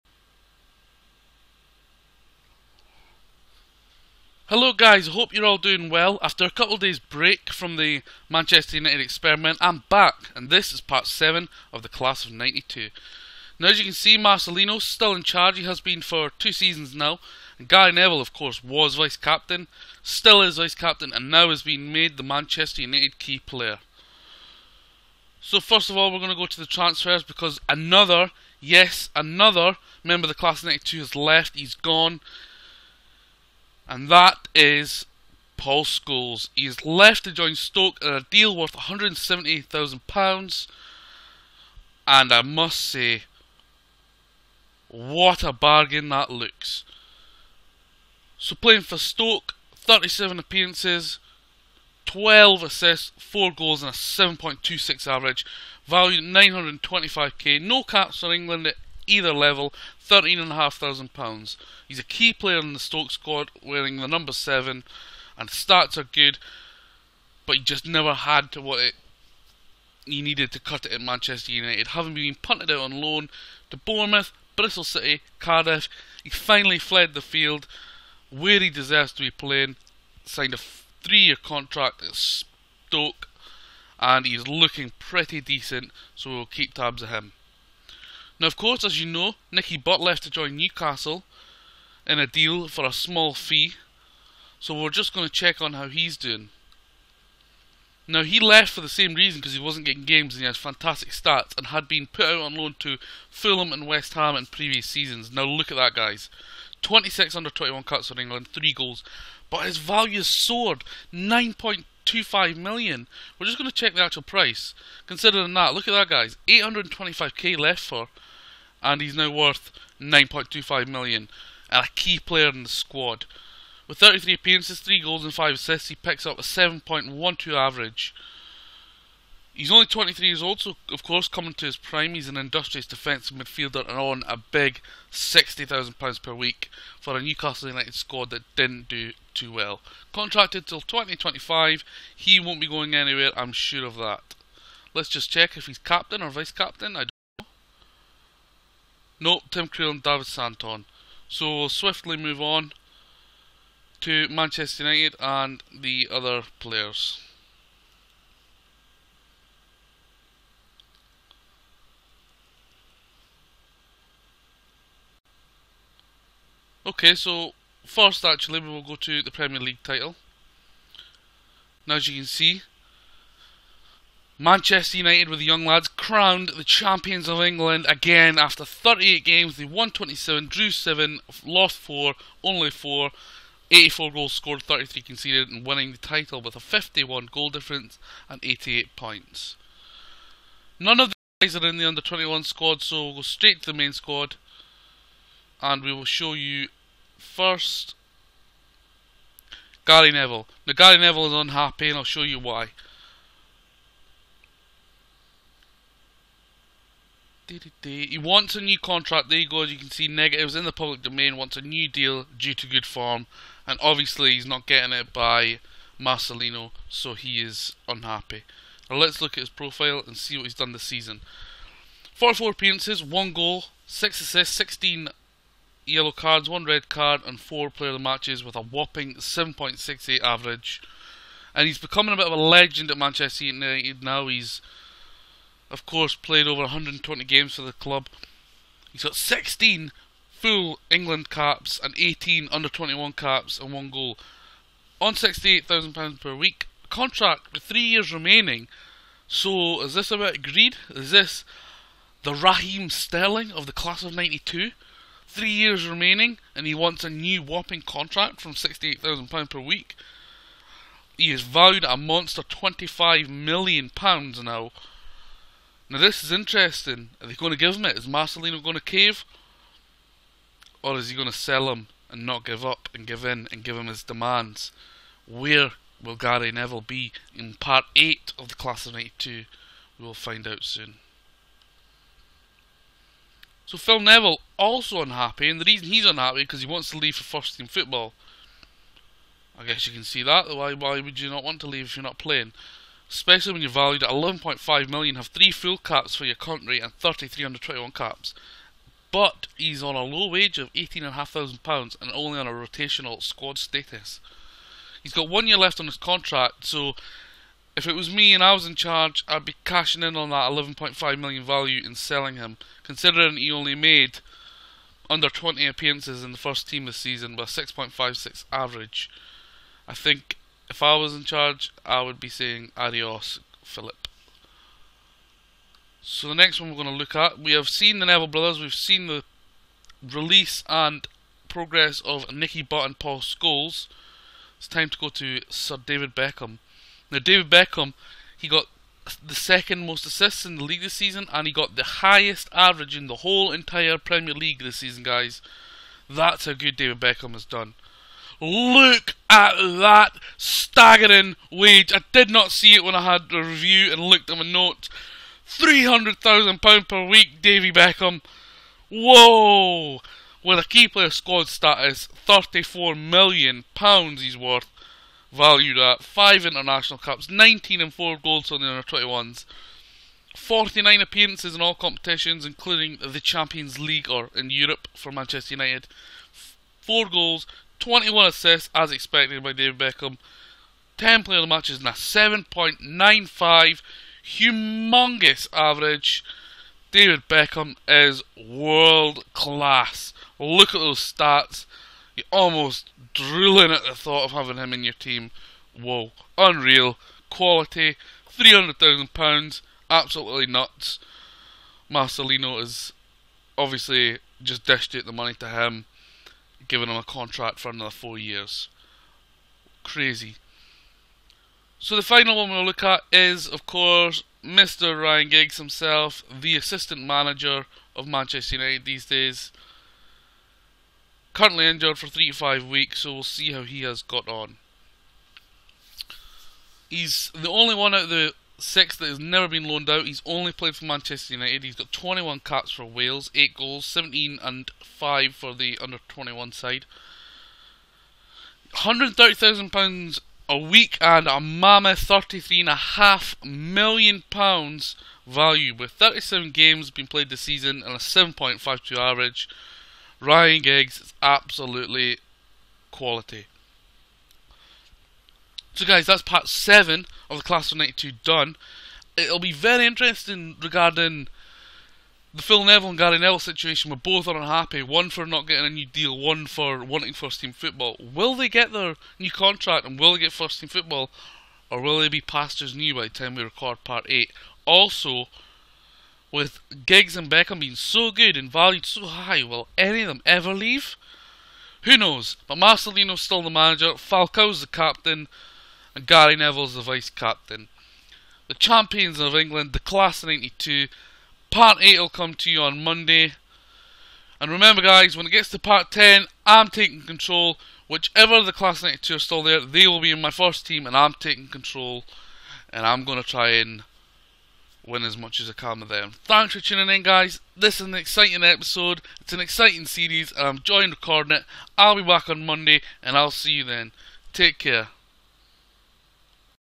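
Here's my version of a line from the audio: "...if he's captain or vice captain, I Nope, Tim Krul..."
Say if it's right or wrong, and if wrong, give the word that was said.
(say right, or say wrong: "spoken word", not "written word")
right.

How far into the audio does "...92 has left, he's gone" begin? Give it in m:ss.
0:30.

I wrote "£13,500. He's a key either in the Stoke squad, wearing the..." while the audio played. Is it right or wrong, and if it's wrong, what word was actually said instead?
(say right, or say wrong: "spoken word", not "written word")
wrong: "player", not "either".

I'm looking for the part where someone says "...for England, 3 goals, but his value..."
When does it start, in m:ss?
1:48.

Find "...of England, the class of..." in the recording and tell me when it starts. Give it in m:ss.
8:09.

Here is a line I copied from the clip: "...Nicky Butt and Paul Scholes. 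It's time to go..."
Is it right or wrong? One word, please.
right.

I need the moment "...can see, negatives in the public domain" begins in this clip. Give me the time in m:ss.
3:29.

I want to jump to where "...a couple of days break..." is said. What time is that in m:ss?
0:06.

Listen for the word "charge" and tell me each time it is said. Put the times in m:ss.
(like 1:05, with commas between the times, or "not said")
0:15, 5:08, 5:21.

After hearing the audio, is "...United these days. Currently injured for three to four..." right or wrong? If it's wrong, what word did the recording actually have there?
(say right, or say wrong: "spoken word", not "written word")
wrong: "five", not "four".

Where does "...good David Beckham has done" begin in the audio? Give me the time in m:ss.
5:46.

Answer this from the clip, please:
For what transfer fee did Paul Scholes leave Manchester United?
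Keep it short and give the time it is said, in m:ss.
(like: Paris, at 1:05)
£170,000, at 0:38.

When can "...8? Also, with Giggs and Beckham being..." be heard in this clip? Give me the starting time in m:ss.
7:54.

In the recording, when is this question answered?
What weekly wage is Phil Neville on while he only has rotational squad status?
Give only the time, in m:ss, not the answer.
5:00.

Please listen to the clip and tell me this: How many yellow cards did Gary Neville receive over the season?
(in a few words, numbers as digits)
16.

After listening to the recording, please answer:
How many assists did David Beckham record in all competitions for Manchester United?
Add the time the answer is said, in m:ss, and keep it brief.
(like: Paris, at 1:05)
21, at 6:17.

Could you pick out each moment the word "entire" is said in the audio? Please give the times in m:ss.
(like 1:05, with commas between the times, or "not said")
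5:43.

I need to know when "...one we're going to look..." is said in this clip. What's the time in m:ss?
5:26.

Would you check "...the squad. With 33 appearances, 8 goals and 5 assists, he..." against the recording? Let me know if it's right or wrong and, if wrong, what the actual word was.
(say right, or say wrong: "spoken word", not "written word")
wrong: "3", not "8".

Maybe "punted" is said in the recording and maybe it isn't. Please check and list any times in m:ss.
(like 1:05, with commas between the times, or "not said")
1:12.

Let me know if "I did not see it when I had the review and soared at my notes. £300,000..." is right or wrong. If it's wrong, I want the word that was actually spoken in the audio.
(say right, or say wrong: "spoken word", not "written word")
wrong: "looked", not "soared".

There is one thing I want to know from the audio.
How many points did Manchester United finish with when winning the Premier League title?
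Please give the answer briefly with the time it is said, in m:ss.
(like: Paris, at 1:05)
88, at 3:08.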